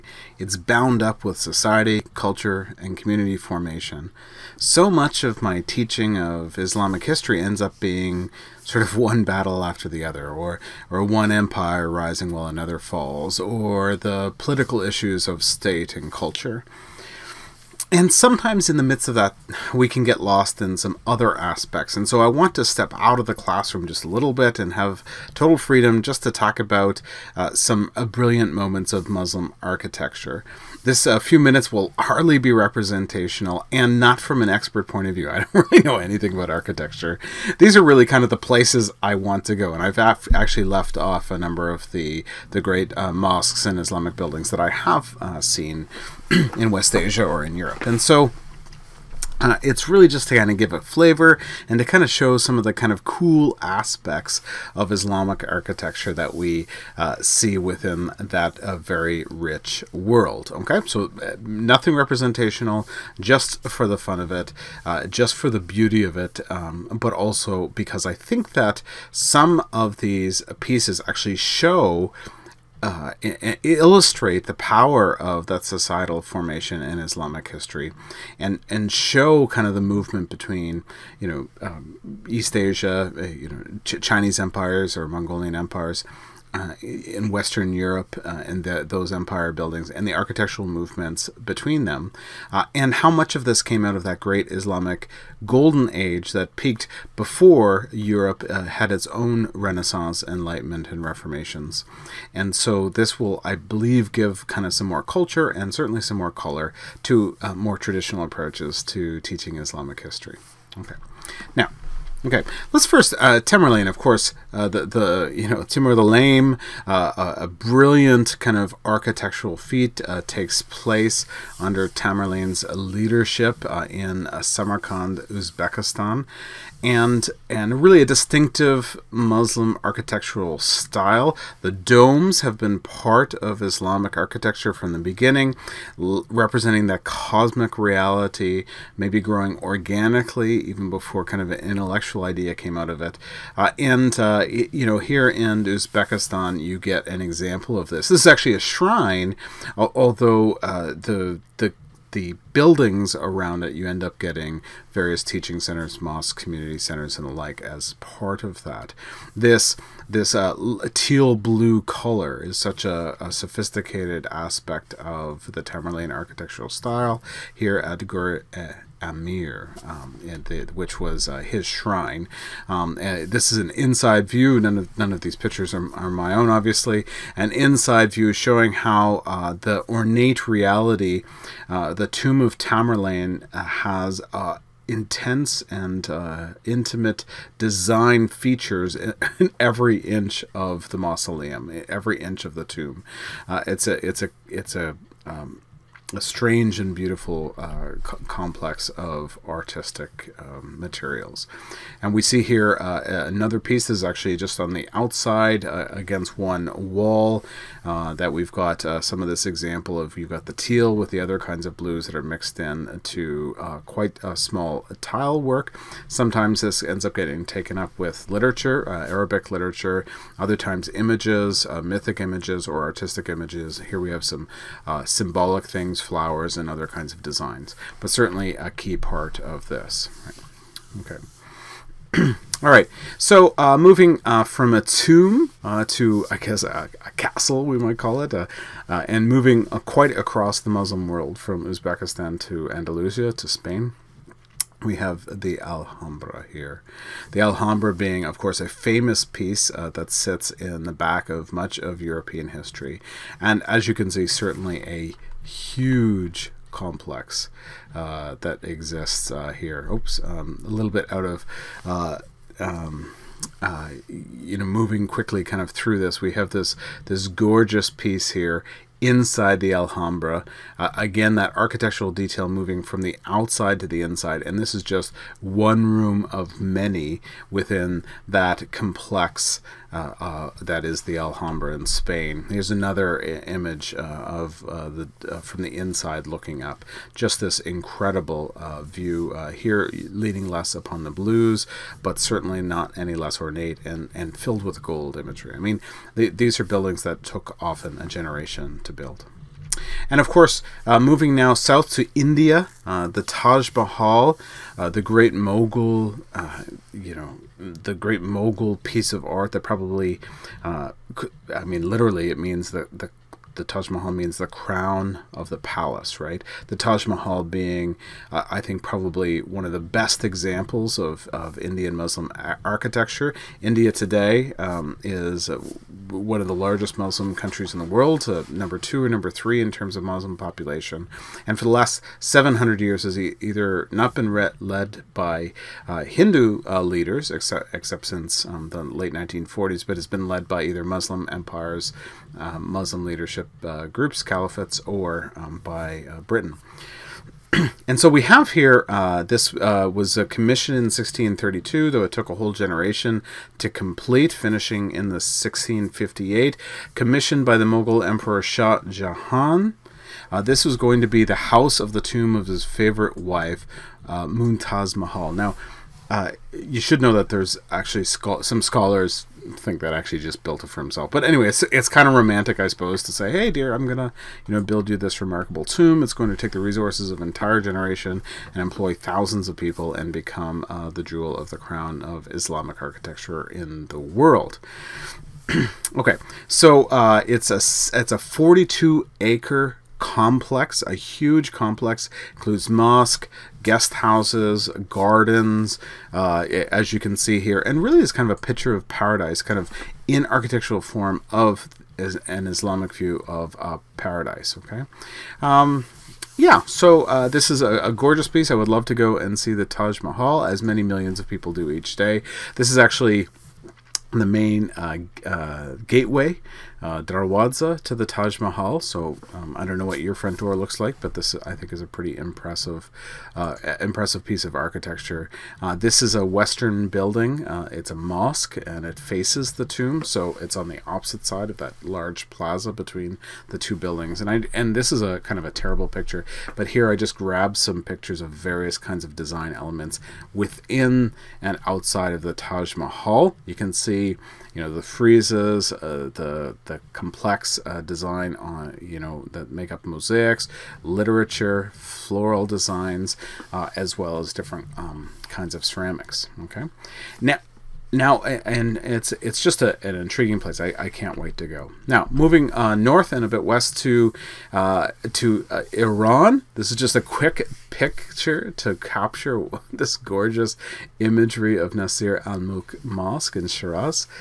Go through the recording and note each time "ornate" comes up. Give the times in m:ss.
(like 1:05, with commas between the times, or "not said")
2:59, 4:53.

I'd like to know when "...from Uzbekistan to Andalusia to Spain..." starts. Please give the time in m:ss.
4:01.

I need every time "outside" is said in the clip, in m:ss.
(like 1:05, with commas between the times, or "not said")
3:24, 4:33, 7:21.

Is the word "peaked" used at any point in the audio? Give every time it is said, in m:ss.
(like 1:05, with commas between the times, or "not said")
1:36.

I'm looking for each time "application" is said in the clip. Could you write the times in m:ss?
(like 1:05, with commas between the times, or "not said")
not said.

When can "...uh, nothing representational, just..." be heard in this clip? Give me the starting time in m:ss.
1:01.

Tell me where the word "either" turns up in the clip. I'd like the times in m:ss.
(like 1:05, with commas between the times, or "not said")
5:33, 5:40.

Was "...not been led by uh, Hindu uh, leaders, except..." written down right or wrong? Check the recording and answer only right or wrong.
right.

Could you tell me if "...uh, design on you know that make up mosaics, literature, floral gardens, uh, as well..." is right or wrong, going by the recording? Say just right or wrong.
wrong.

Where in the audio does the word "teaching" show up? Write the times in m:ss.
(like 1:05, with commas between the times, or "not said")
0:05, 1:49, 2:35.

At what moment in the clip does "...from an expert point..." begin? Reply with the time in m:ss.
0:34.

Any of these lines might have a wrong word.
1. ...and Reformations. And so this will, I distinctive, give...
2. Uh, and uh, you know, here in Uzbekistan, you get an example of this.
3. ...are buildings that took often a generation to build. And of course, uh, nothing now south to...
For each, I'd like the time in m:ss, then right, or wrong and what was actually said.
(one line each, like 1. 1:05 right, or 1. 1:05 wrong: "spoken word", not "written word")
1. 1:40 wrong: "believe", not "distinctive"
2. 2:23 right
3. 4:56 wrong: "moving", not "nothing".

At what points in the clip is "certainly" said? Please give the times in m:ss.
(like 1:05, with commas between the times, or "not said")
1:45, 3:48, 4:14, 4:52.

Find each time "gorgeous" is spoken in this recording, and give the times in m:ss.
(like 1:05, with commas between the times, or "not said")
4:27, 6:47, 7:49.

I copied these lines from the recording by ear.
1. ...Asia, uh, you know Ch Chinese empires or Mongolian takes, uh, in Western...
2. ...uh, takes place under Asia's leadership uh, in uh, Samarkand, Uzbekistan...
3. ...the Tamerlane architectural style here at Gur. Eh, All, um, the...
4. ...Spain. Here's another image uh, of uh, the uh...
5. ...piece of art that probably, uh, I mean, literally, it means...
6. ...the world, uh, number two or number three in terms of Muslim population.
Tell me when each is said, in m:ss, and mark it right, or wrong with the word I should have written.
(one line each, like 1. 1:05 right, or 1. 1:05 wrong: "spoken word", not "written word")
1. 1:22 wrong: "empires", not "takes"
2. 2:00 wrong: "Tamerlane", not "Asia"
3. 2:45 wrong: "Amir", not "All"
4. 4:41 right
5. 5:08 right
6. 5:27 right.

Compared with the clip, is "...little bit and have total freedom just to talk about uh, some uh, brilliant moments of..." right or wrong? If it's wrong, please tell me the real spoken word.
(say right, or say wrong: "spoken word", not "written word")
right.